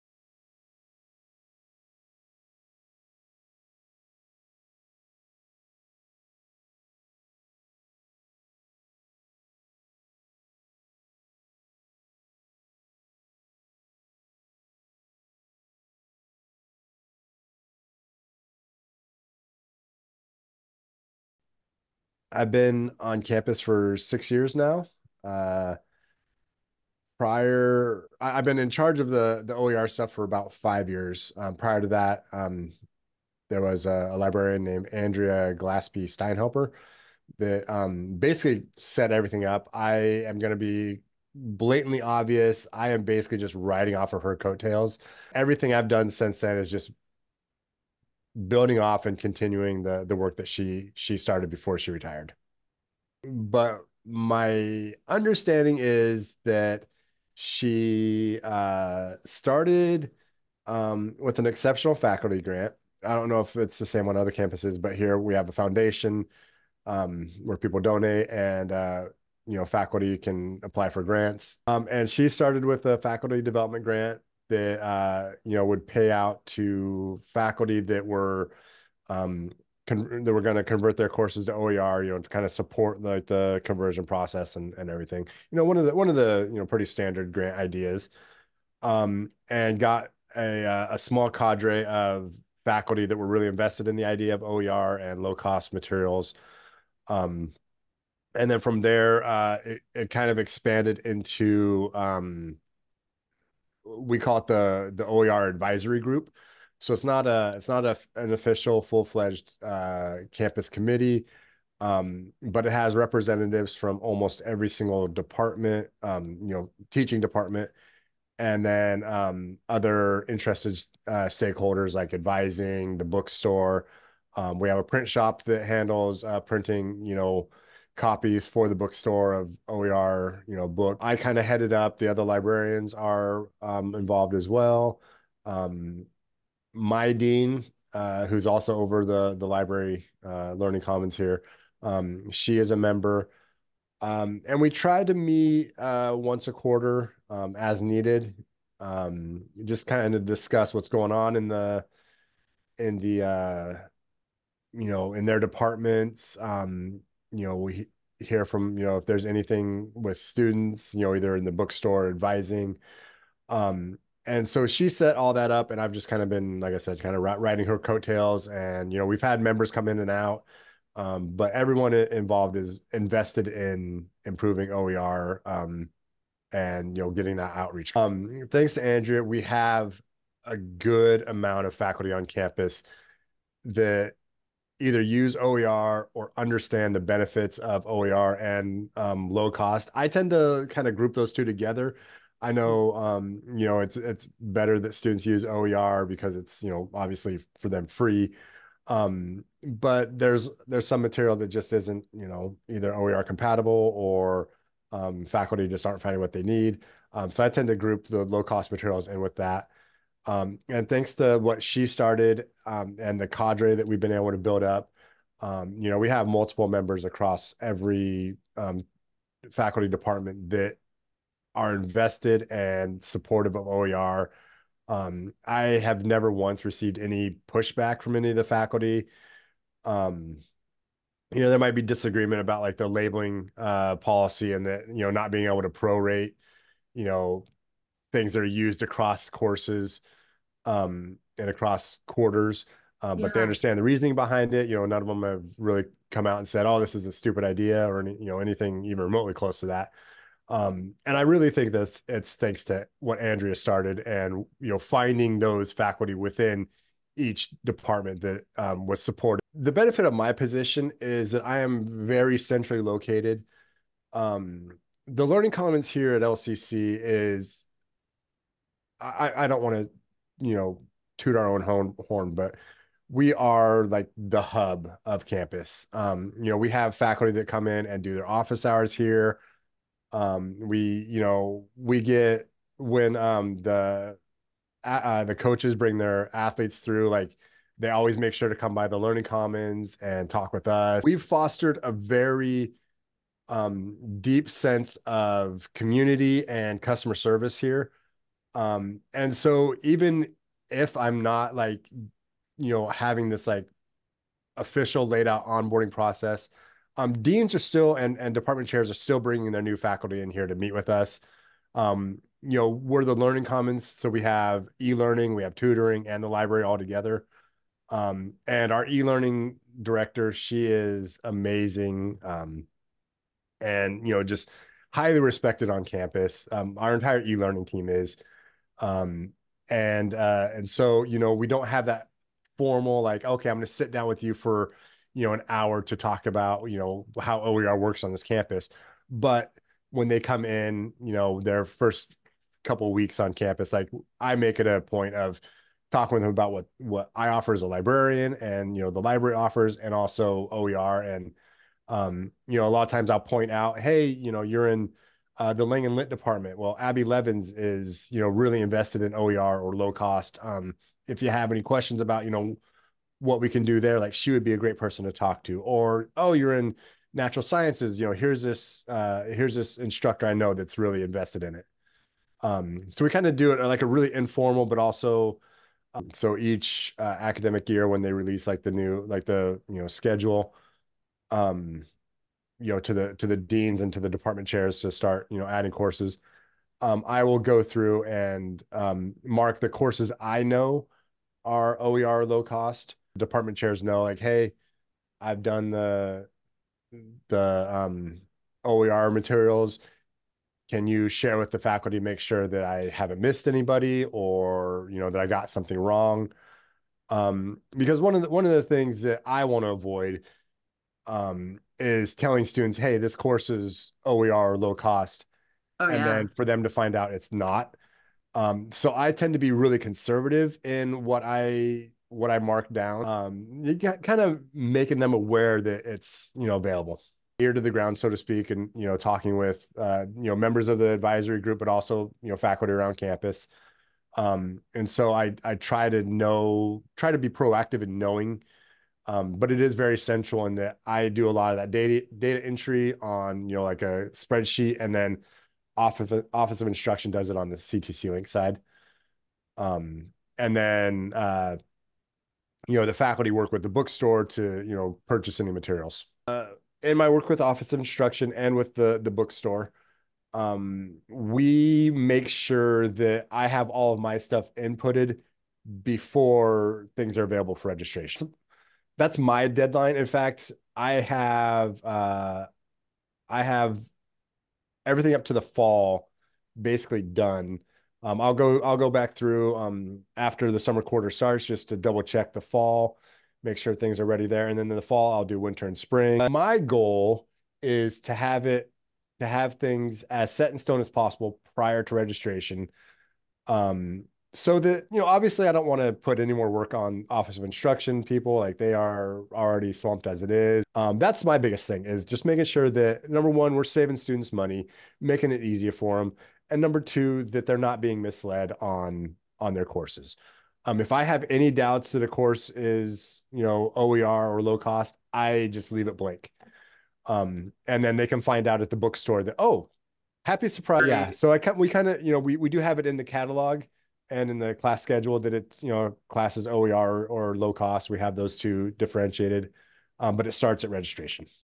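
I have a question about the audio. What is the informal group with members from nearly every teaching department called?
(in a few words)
OER advisory group.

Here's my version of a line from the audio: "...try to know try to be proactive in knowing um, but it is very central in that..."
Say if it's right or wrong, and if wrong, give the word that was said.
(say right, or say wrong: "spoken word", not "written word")
right.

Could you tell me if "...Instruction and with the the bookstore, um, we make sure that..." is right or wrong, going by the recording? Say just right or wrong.
right.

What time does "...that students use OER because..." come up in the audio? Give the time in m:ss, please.
3:14.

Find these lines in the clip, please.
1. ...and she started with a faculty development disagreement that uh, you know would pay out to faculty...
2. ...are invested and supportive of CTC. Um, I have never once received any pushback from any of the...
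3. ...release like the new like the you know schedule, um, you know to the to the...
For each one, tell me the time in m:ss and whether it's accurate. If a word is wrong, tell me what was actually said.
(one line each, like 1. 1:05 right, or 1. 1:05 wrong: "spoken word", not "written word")
1. 1:11 wrong: "grant", not "disagreement"
2. 3:41 wrong: "OER", not "CTC"
3. 6:18 right.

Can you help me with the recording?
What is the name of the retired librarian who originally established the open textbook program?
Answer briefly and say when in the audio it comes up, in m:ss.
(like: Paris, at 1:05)
Andrea Glaspie Steinhelper, at 0:34.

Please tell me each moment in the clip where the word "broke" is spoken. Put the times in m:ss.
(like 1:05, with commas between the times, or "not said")
not said.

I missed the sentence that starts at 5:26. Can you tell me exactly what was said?
Um, our entire e-learning team is.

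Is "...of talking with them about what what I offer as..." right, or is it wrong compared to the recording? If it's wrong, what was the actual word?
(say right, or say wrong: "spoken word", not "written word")
right.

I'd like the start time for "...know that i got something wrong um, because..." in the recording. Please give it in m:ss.
6:44.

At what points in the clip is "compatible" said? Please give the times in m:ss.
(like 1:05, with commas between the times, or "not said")
3:23.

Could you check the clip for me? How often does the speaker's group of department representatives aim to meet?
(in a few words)
Once a quarter.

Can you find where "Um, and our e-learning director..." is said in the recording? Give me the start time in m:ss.
5:17.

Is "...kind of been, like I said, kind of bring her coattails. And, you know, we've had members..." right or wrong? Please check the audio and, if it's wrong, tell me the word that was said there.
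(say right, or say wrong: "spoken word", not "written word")
wrong: "riding", not "bring".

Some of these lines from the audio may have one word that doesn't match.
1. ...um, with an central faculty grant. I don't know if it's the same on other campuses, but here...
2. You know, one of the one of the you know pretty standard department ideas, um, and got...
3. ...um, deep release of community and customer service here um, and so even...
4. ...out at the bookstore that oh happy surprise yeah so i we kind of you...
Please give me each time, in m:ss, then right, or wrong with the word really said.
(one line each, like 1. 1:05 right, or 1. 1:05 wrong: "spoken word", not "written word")
1. 1:00 wrong: "exceptional", not "central"
2. 1:25 wrong: "grant", not "department"
3. 4:53 wrong: "sense", not "release"
4. 8:38 right.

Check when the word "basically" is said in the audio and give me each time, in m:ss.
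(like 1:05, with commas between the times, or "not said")
0:38, 0:43, 7:56.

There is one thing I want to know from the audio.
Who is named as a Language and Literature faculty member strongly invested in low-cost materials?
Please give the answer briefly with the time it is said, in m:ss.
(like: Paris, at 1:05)
Abby Levins, at 5:56.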